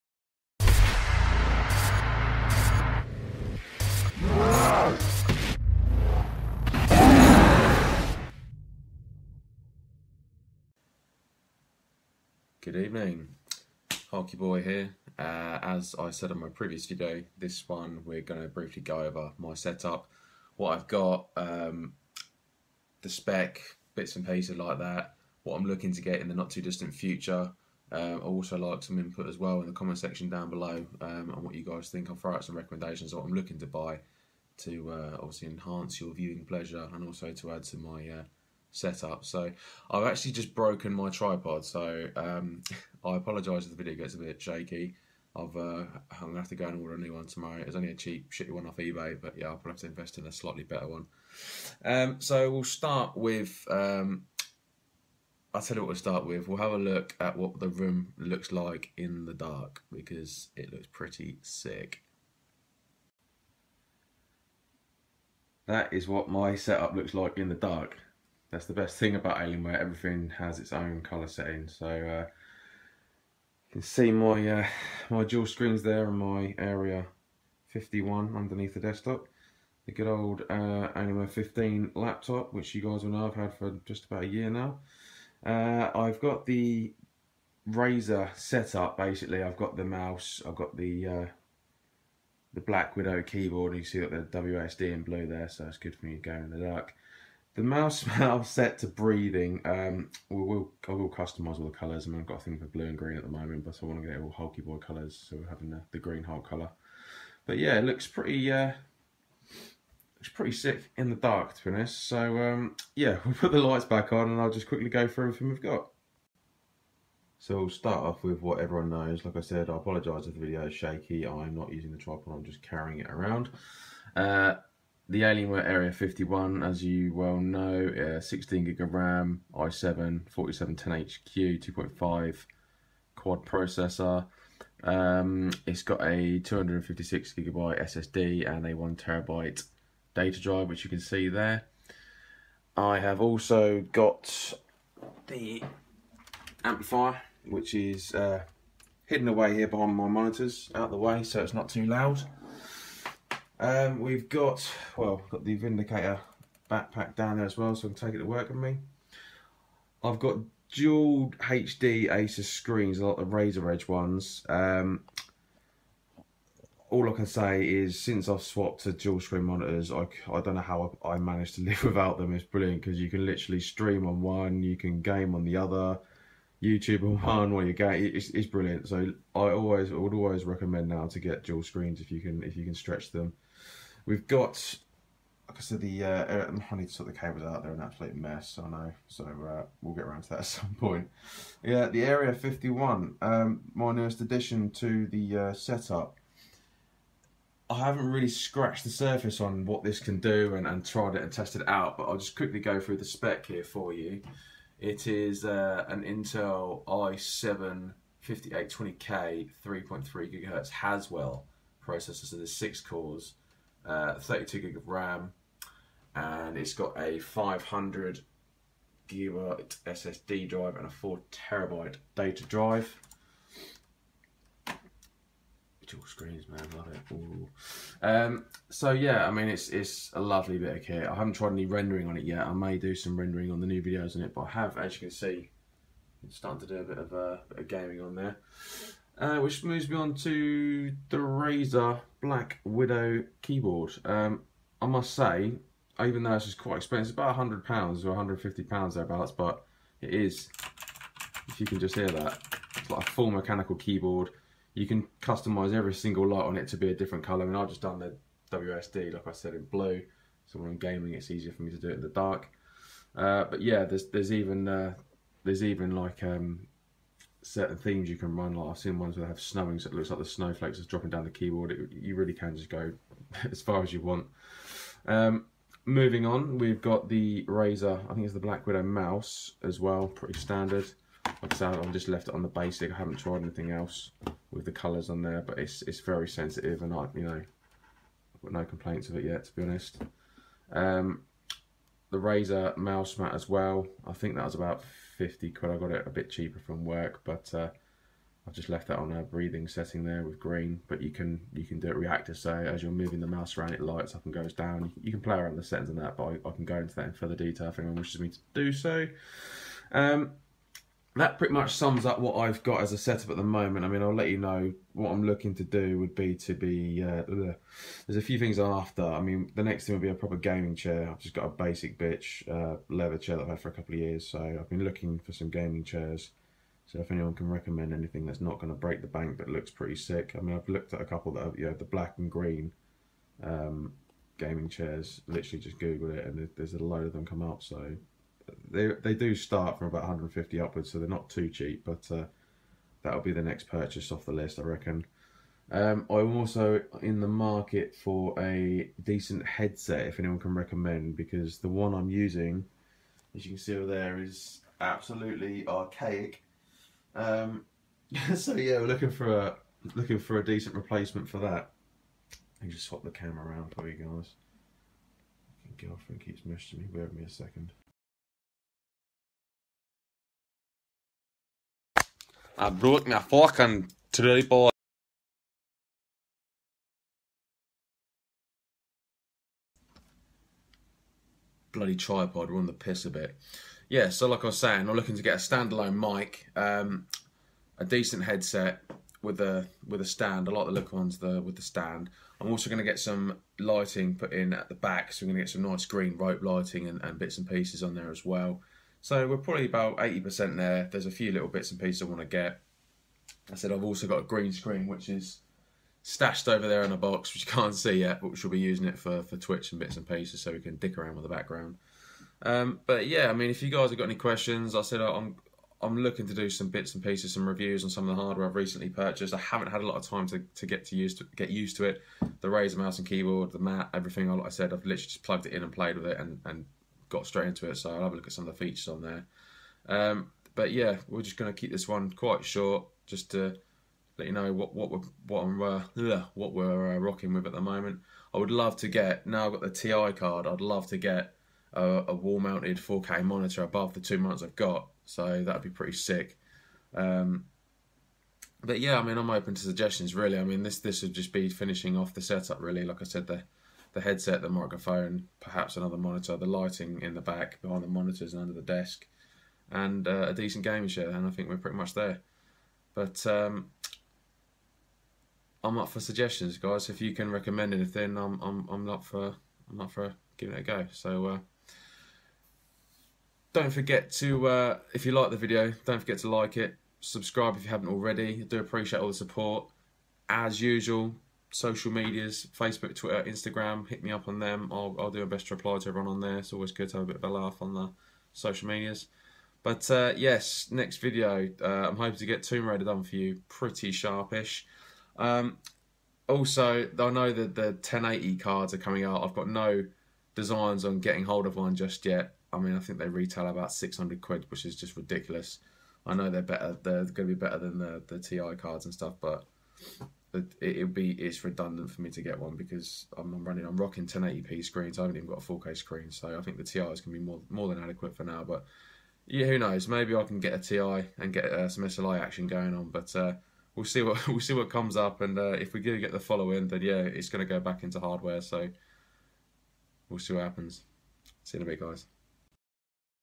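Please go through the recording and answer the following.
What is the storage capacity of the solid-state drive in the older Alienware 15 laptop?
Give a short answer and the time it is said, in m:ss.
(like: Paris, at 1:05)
256 gigabytes, at 2:16.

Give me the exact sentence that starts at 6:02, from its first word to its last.
I can just swap the camera around for you guys.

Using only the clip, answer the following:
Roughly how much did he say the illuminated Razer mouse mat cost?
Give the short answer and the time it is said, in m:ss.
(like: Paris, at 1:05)
50 quid, at 4:55.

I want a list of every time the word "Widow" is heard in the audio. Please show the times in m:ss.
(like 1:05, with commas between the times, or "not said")
1:32, 4:02, 4:38.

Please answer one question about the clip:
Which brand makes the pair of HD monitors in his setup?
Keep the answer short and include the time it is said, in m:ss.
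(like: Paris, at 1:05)
Asus, at 2:42.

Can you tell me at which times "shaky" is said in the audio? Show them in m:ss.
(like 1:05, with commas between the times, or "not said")
0:44, 2:00.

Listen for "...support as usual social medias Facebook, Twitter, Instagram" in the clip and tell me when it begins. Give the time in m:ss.
7:59.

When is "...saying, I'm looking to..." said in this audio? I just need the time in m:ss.
6:24.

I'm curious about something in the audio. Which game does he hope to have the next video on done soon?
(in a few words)
Tomb Raider.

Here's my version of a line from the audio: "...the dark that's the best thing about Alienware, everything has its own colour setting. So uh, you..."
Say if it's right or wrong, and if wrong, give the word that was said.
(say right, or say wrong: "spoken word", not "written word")
right.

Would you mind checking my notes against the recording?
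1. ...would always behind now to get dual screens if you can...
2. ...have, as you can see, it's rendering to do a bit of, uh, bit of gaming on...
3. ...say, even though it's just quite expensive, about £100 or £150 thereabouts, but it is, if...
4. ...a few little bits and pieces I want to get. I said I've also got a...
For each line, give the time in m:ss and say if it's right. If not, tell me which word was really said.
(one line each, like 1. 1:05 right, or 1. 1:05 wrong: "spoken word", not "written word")
1. 2:59 wrong: "recommend", not "behind"
2. 3:54 wrong: "starting", not "rendering"
3. 4:05 right
4. 6:41 right.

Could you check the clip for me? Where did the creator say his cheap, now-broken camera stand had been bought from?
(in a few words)
eBay.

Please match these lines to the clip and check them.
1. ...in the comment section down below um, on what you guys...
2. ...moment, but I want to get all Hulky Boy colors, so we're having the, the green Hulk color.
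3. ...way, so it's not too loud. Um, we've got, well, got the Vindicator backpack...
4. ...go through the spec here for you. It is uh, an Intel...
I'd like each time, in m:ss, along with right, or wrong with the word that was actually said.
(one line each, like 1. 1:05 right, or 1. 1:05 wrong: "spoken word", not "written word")
1. 0:29 right
2. 1:43 right
3. 2:30 right
4. 3:22 right.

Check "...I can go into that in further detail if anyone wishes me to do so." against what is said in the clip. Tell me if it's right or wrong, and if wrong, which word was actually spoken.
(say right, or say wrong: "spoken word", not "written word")
right.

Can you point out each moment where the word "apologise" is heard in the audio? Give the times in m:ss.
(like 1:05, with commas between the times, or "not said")
0:43, 1:59.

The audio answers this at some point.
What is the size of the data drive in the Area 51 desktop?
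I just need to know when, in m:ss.
3:40.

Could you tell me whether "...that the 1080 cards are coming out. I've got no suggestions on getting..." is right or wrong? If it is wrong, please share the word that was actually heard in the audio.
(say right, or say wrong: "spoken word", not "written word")
wrong: "designs", not "suggestions".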